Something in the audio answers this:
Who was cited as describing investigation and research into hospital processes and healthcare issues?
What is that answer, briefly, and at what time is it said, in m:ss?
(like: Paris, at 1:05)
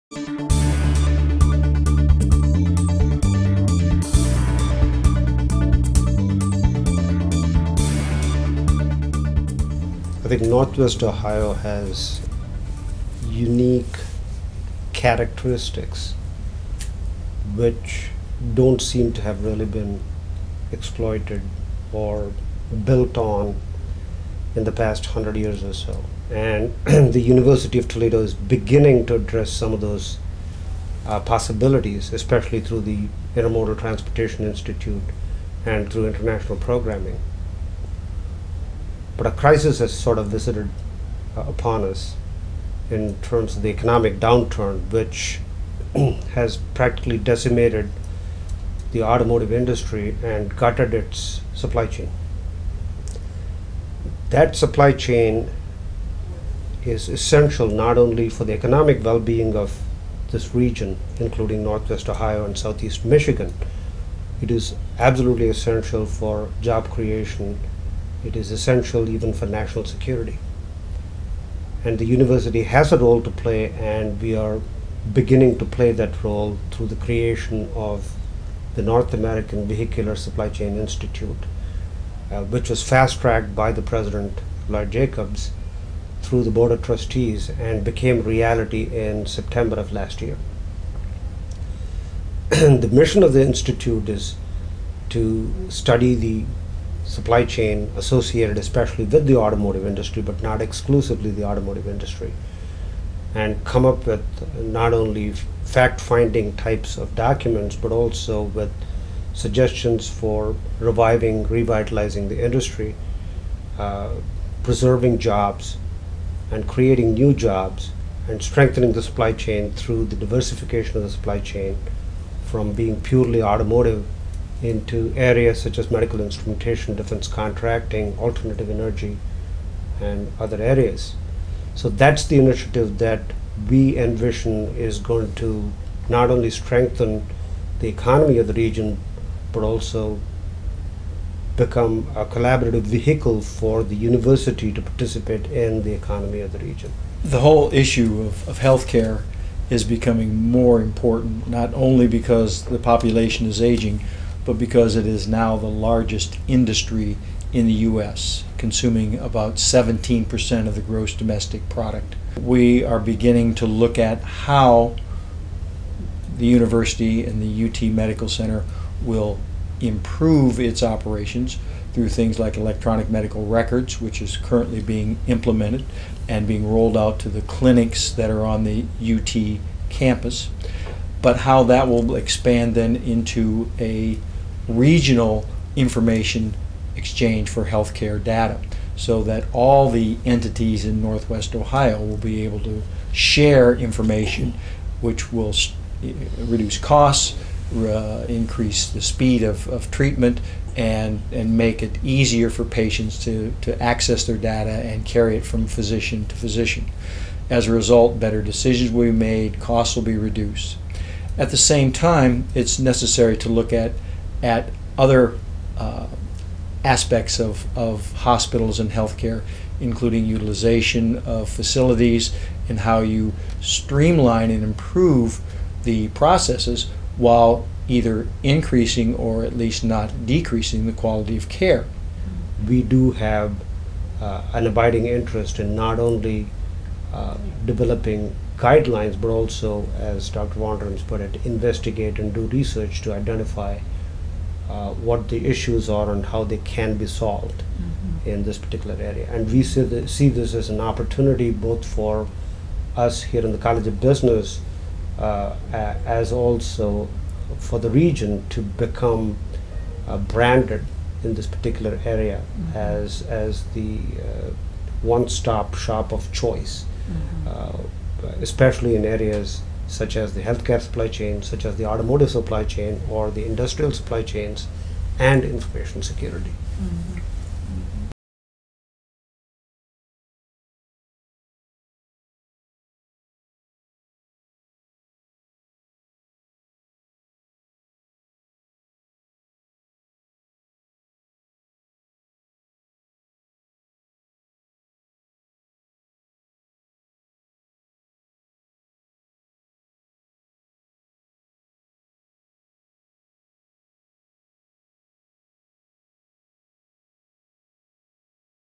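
Dr. Vonderembse, at 4:00.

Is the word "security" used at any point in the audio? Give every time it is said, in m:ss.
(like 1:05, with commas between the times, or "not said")
1:09, 4:36.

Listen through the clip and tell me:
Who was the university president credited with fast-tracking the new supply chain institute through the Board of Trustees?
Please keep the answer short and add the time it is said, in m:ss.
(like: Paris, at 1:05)
Lloyd Jacobs, at 1:24.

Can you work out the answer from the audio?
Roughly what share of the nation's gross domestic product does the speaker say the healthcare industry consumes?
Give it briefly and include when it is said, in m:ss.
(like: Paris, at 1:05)
17%, at 2:39.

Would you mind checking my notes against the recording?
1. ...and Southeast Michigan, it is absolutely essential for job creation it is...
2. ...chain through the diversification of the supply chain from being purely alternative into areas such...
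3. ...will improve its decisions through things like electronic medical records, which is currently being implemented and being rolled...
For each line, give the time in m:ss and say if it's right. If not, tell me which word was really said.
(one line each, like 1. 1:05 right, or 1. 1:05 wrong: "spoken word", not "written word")
1. 1:02 right
2. 1:59 wrong: "automotive", not "alternative"
3. 2:49 wrong: "operations", not "decisions".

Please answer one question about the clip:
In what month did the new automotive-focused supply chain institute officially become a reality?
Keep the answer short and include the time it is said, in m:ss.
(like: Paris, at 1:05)
September, at 1:29.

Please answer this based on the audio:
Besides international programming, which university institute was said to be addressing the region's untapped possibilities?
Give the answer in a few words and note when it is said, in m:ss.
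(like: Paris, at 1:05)
Intermodal Transportation Institute, at 0:33.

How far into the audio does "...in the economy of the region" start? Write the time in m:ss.
2:25.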